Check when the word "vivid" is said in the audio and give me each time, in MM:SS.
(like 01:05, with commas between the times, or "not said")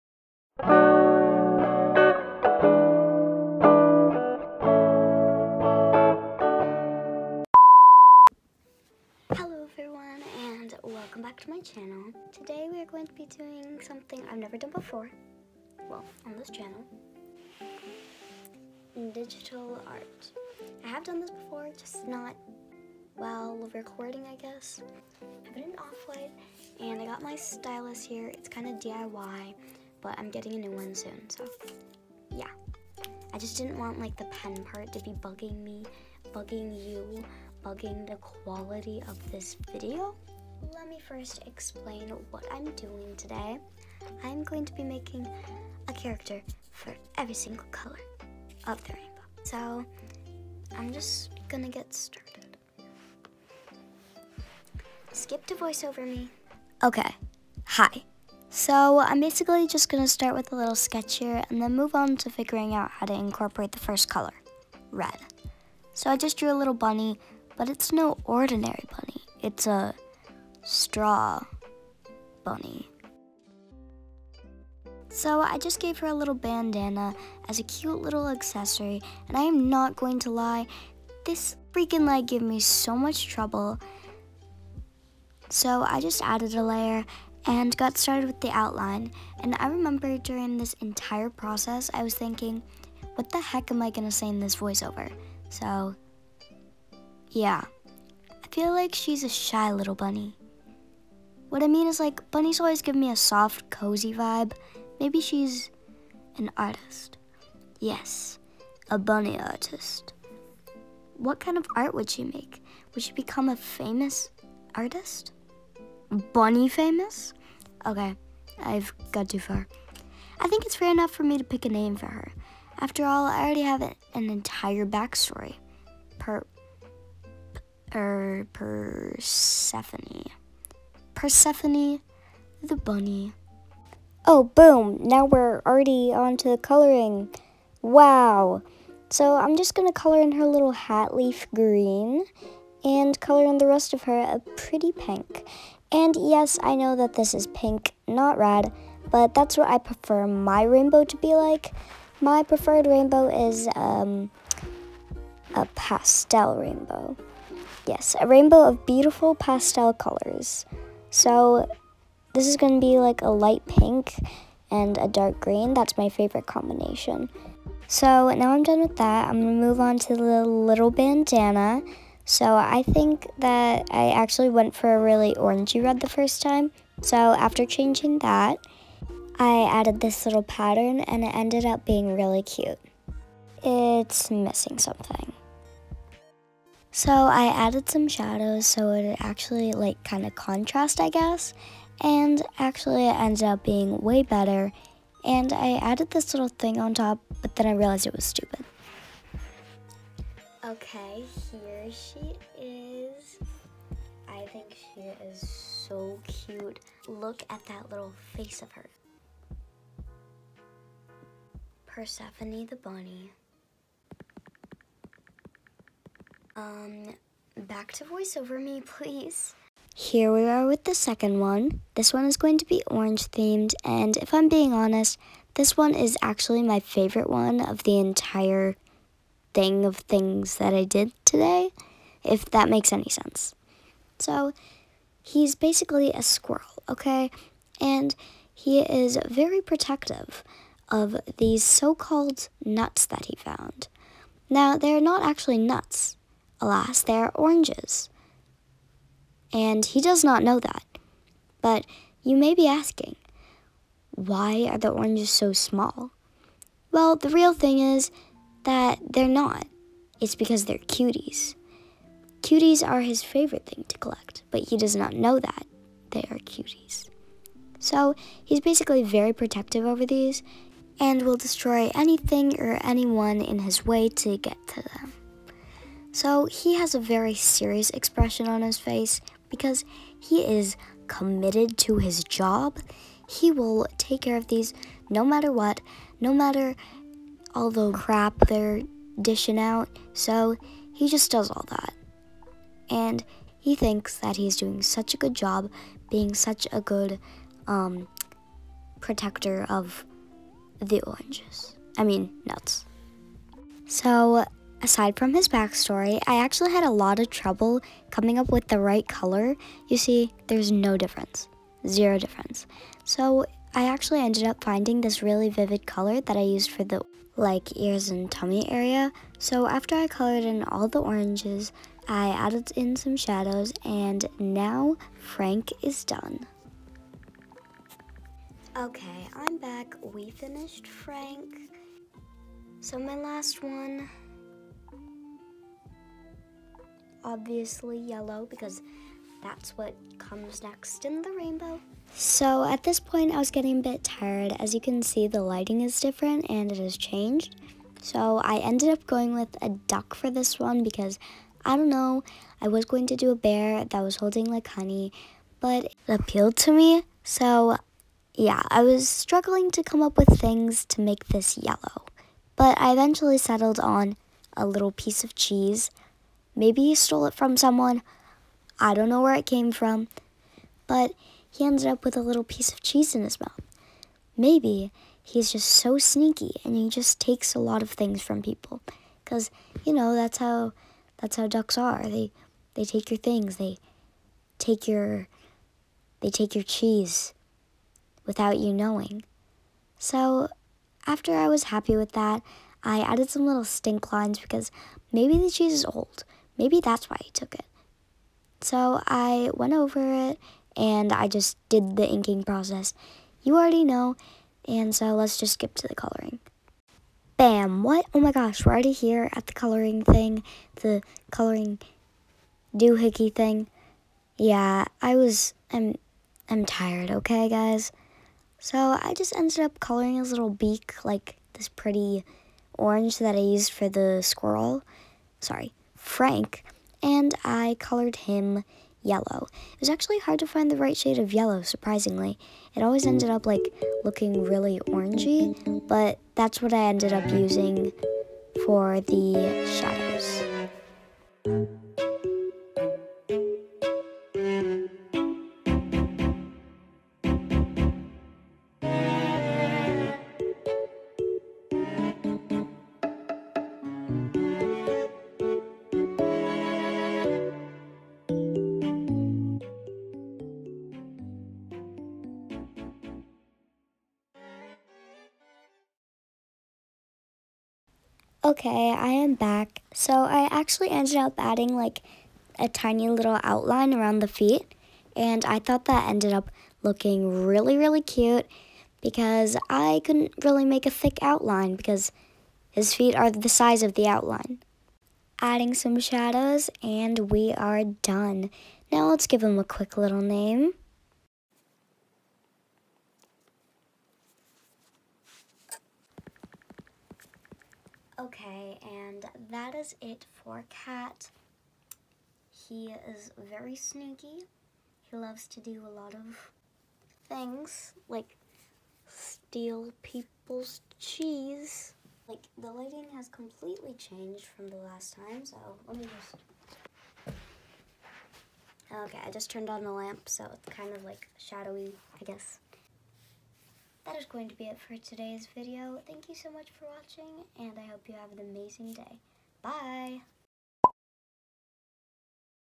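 05:15.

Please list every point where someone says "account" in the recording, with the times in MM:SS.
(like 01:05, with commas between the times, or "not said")
not said.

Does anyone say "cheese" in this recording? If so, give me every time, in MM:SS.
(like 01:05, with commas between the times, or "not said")
06:05, 06:12, 06:26, 06:35, 08:30.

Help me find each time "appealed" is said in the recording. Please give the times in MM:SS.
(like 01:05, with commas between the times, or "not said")
05:56.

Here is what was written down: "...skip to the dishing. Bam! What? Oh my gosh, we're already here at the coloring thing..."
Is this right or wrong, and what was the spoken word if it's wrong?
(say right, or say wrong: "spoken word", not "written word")
wrong: "coloring", not "dishing".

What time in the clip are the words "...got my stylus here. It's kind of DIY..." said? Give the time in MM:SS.
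00:27.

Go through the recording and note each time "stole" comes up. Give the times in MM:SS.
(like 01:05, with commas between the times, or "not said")
06:06.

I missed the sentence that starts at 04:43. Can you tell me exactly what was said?
He will take care of these no matter what, no matter all the crap they're dishing out.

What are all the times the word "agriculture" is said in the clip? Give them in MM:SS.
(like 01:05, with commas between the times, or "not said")
not said.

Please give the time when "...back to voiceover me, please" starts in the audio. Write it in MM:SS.
03:37.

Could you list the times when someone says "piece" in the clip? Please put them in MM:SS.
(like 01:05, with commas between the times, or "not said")
06:04, 06:12.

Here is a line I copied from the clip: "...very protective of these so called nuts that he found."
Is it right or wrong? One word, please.
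right.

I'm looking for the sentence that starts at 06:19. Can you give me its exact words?
Because, you know, that's how that's how ducks are.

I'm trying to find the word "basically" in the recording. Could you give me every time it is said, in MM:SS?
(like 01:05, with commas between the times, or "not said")
00:59, 03:55, 04:28.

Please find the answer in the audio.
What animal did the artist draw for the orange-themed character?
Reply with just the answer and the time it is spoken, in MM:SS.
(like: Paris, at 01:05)
A squirrel, at 03:56.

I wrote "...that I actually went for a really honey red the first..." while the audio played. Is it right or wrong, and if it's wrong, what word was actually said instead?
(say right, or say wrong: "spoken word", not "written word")
wrong: "orangey", not "honey".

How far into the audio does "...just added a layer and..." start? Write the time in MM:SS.
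01:25.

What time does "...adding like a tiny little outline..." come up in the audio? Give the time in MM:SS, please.
07:51.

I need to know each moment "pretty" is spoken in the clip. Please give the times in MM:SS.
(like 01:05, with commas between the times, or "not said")
02:24, 07:01.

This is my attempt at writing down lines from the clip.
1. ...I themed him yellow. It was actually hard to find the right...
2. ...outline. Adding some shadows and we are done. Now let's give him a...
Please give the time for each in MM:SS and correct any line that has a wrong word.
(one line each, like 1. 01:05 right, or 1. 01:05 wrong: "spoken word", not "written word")
1. 07:07 wrong: "colored", not "themed"
2. 08:04 right.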